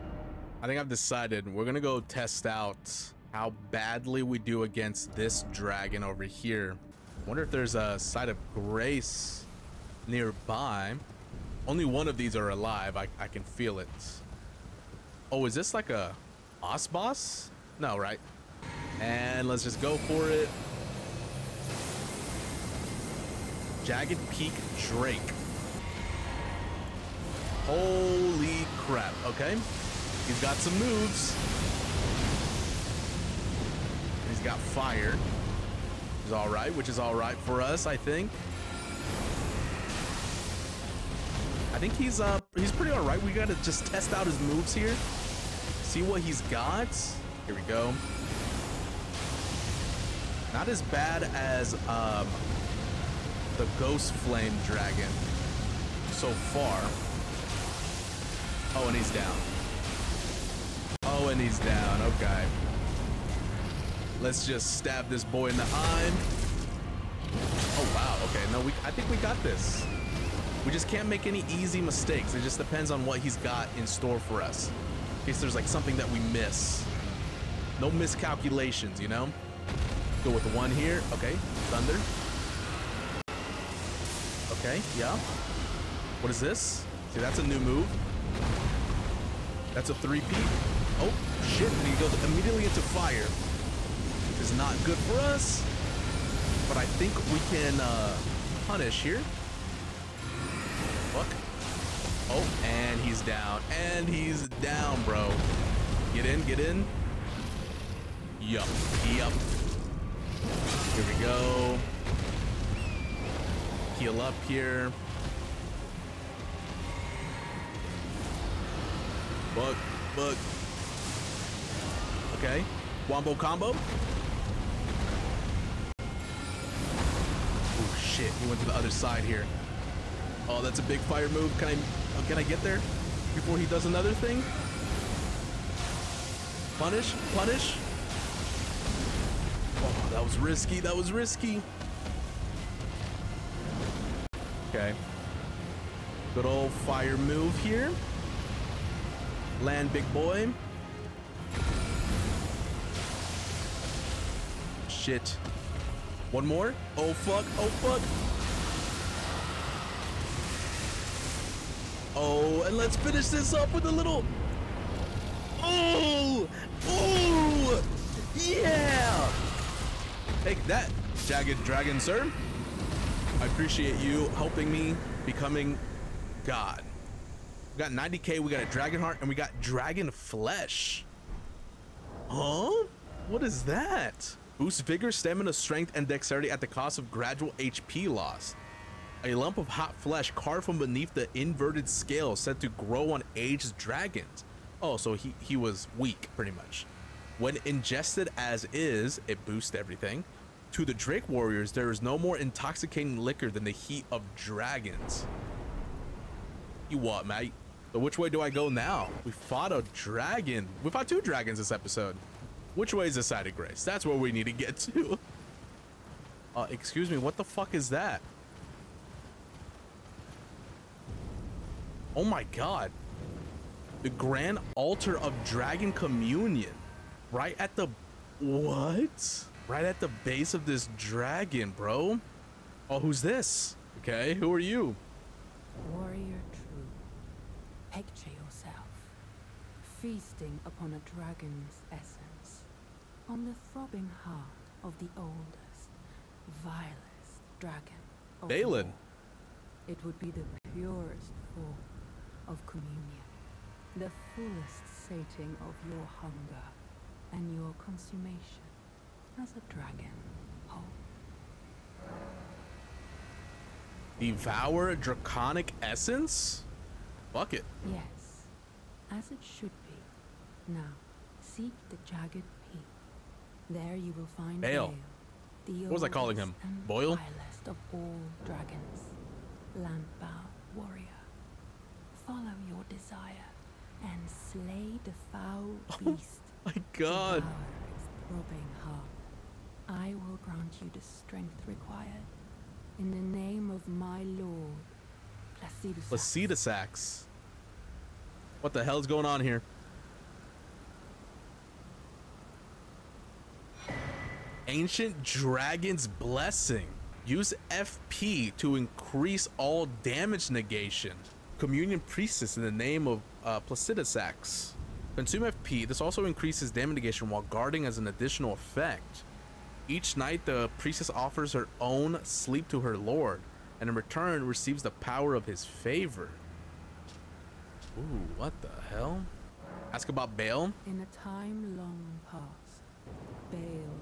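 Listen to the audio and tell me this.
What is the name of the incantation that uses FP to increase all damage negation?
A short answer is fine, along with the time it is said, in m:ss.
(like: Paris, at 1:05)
Ancient Dragon's Blessing, at 5:04.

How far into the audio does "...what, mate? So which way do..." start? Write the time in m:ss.
3:26.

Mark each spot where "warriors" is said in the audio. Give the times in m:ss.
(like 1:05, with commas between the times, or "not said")
3:21, 3:55, 4:40.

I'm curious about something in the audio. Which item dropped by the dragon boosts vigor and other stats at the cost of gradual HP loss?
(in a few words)
Dragon flesh.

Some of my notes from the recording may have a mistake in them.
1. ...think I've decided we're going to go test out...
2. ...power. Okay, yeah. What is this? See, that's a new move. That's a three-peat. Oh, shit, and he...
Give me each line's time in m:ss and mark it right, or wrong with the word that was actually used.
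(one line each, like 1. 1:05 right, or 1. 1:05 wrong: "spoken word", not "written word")
1. 0:00 right
2. 1:21 wrong: "thunder", not "power".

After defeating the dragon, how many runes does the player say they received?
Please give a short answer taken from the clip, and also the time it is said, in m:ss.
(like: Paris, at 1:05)
90k, at 2:57.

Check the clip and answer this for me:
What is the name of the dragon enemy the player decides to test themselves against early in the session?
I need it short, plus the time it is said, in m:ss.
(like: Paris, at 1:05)
Jagged Peak Drake, at 0:23.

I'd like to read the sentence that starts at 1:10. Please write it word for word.
We just can't make any easy mistakes.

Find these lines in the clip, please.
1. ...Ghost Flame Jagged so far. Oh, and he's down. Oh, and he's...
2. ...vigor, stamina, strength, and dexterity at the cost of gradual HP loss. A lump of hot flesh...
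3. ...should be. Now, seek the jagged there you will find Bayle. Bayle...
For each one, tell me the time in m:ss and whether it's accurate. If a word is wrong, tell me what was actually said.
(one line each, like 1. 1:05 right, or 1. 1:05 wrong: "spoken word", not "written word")
1. 0:53 wrong: "Dragon", not "Jagged"
2. 3:04 right
3. 4:29 right.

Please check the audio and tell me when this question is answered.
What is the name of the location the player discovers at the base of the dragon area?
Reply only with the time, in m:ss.
3:44.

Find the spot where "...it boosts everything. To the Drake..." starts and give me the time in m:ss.
3:19.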